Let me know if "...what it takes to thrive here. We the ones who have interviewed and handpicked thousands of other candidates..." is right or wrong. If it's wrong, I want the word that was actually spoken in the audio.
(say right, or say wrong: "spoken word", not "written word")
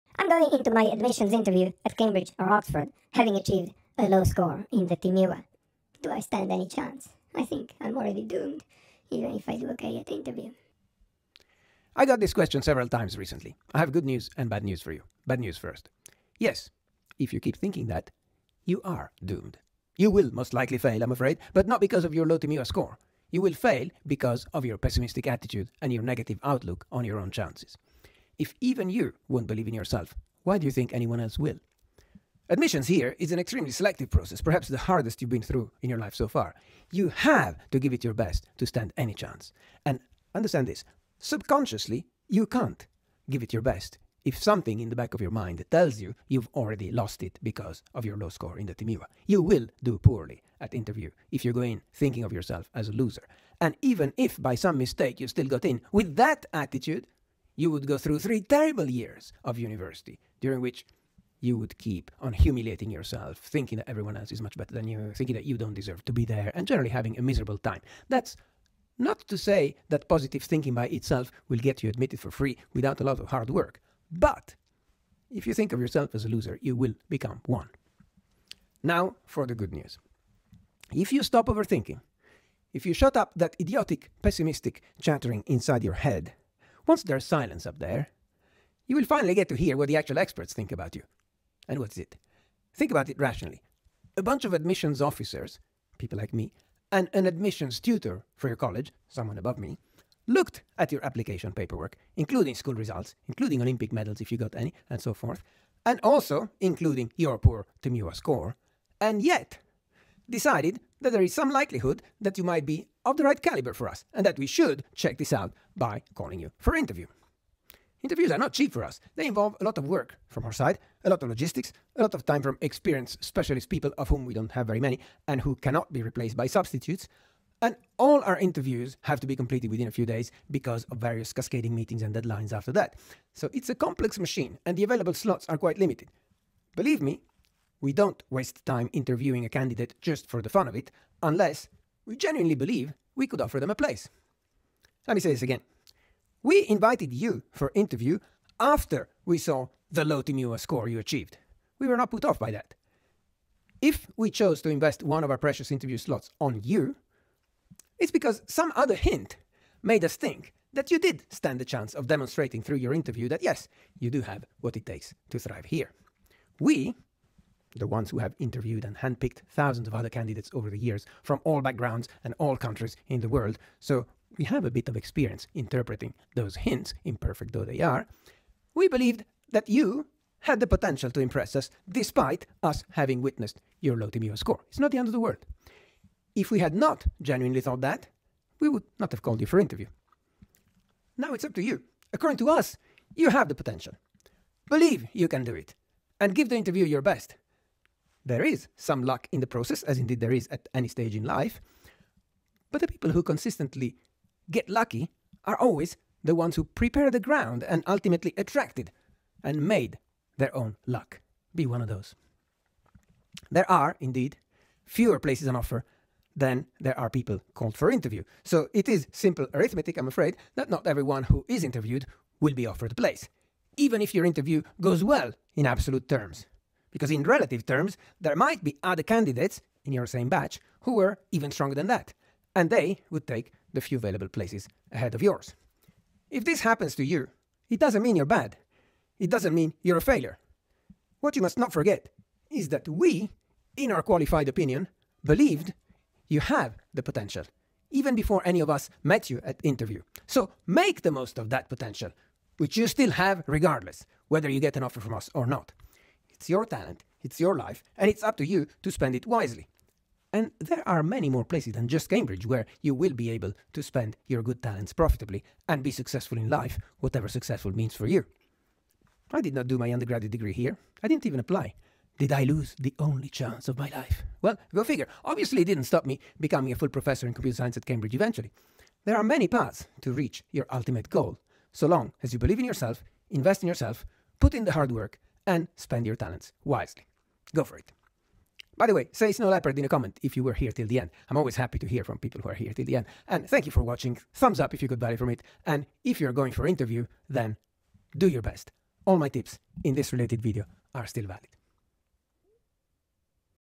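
right.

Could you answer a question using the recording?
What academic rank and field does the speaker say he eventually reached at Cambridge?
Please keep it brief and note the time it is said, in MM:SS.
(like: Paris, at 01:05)
full professor in computer science, at 04:36.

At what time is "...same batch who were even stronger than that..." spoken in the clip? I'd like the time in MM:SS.
03:50.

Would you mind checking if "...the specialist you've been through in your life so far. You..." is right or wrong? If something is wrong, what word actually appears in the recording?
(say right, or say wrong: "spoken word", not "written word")
wrong: "hardest", not "specialist".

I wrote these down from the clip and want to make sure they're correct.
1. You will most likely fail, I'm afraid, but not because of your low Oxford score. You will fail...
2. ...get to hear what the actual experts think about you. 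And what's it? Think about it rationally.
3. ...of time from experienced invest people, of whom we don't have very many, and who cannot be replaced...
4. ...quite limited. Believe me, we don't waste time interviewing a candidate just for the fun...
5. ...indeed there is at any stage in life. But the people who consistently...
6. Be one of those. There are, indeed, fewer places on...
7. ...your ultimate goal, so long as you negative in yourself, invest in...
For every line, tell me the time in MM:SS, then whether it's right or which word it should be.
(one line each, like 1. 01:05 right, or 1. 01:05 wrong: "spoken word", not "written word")
1. 00:19 wrong: "TMUA", not "Oxford"
2. 01:29 right
3. 02:02 wrong: "specialist", not "invest"
4. 02:15 right
5. 03:19 right
6. 03:31 right
7. 04:40 wrong: "believe", not "negative".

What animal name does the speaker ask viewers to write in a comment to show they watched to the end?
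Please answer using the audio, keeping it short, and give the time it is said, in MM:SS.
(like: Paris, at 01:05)
Snow Leopard, at 04:49.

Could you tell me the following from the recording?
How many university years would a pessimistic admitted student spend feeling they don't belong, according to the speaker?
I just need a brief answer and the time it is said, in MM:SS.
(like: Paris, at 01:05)
3, at 00:58.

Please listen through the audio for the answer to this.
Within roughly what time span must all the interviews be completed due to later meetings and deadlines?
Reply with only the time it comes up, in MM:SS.
02:09.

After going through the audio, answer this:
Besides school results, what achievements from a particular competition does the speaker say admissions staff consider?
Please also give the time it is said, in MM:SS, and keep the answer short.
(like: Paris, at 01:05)
Olympic medals, at 01:43.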